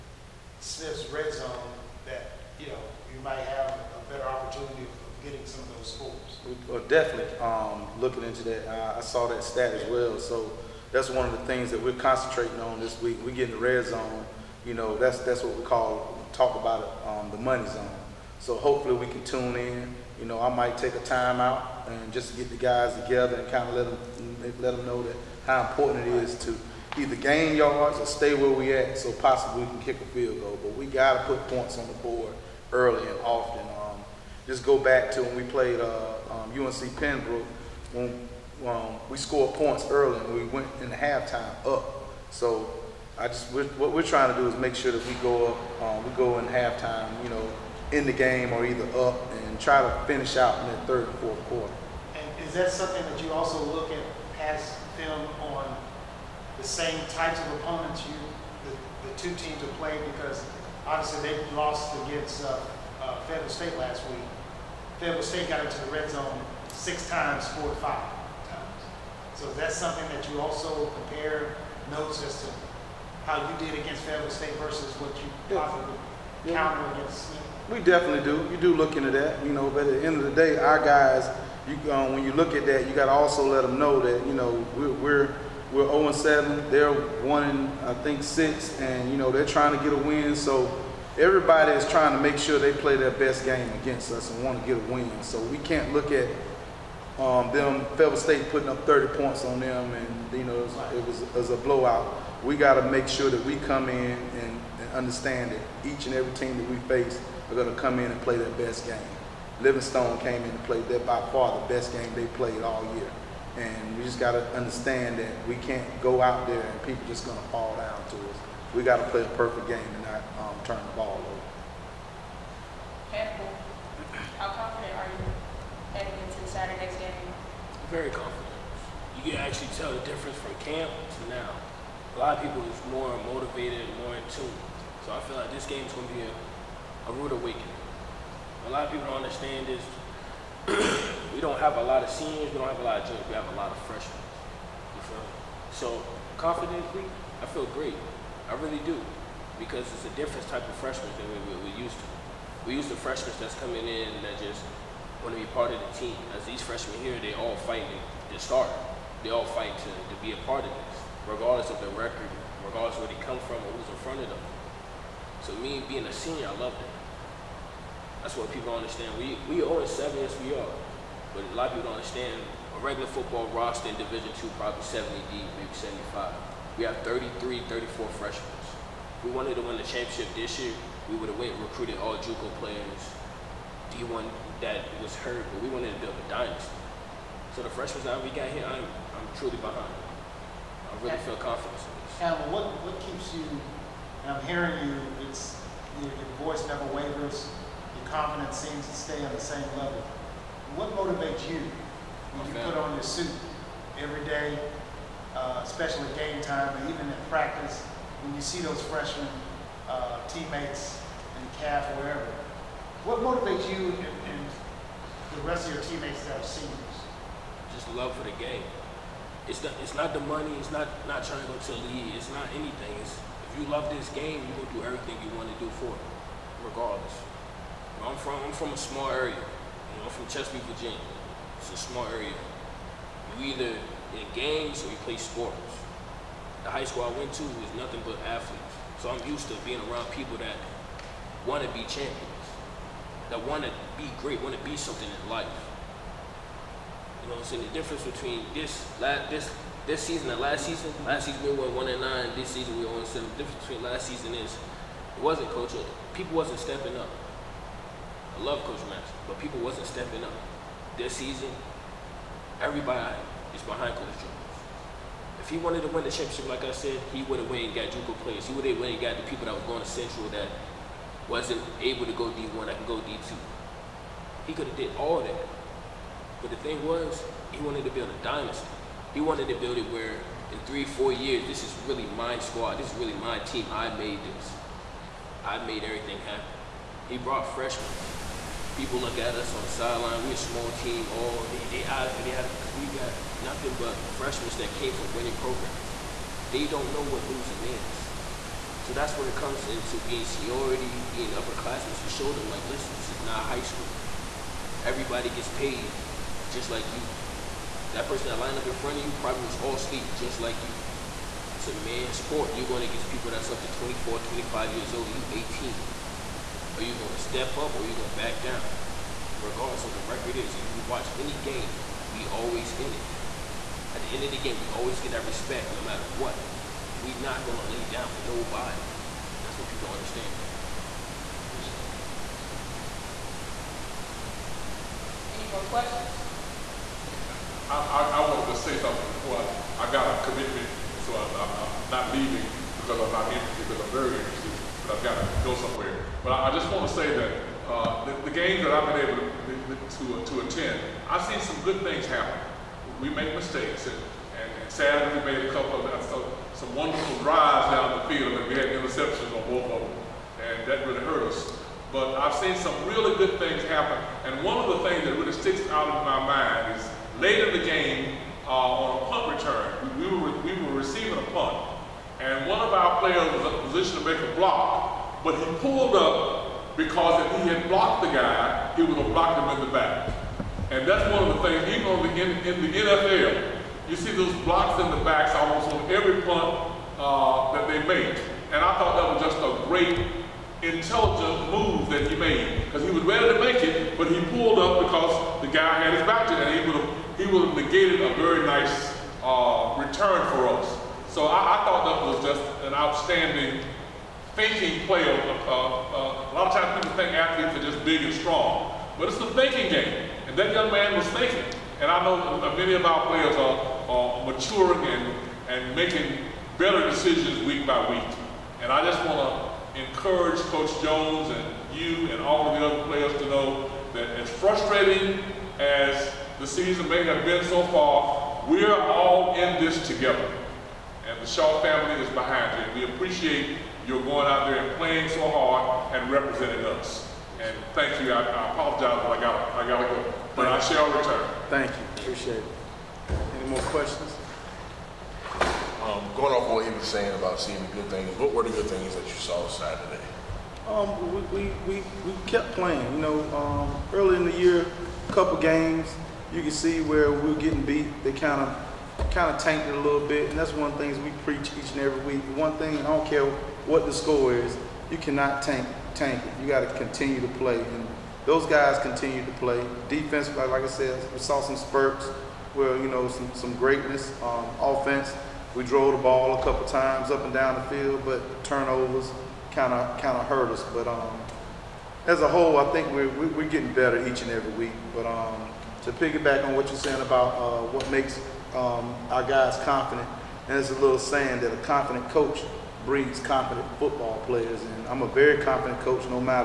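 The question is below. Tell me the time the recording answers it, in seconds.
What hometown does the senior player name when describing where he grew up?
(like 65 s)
230 s.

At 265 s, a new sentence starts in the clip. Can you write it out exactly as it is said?
If he wanted to win the championship, like I said, he would have went and got Juco players.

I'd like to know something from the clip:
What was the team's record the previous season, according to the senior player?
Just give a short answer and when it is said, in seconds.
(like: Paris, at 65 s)
1-9, at 251 s.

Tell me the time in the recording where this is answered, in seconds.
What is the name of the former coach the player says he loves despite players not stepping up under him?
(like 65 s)
258 s.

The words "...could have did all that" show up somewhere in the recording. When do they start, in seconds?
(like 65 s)
274 s.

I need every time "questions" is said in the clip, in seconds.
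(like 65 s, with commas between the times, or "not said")
335 s, 443 s.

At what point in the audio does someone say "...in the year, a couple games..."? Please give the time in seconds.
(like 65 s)
454 s.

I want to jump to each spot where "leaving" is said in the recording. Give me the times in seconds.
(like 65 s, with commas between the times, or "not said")
342 s.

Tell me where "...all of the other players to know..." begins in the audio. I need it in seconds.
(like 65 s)
422 s.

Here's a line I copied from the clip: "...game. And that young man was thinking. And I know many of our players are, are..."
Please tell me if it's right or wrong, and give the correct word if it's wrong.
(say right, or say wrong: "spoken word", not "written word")
right.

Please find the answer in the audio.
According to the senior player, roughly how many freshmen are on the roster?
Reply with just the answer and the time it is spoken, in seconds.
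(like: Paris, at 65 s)
33 or 34, at 176 s.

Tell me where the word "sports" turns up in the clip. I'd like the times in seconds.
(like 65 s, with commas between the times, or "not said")
235 s, 312 s.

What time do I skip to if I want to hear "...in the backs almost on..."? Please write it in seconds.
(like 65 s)
384 s.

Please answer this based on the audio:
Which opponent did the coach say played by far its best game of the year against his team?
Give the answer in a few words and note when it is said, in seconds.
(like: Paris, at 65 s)
Livingstone, at 109 s.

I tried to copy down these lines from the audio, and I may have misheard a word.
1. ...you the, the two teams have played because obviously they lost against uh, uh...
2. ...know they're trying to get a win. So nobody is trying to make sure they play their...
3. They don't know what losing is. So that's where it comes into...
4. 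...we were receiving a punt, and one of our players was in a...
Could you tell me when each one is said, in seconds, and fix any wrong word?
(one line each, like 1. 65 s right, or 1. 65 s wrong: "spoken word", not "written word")
1. 58 s right
2. 89 s wrong: "everybody", not "nobody"
3. 296 s right
4. 370 s right.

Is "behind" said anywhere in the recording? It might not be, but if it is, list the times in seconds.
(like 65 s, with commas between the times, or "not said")
189 s, 263 s, 432 s.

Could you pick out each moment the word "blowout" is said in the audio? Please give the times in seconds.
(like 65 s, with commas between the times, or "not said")
101 s.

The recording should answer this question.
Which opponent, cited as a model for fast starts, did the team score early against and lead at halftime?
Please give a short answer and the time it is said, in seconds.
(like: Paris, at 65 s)
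UNC Pembroke, at 36 s.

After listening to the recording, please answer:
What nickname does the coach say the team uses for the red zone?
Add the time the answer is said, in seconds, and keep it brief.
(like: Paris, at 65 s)
the money zone, at 17 s.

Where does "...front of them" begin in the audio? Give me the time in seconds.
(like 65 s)
164 s.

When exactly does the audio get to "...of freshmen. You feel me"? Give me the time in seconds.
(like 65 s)
143 s.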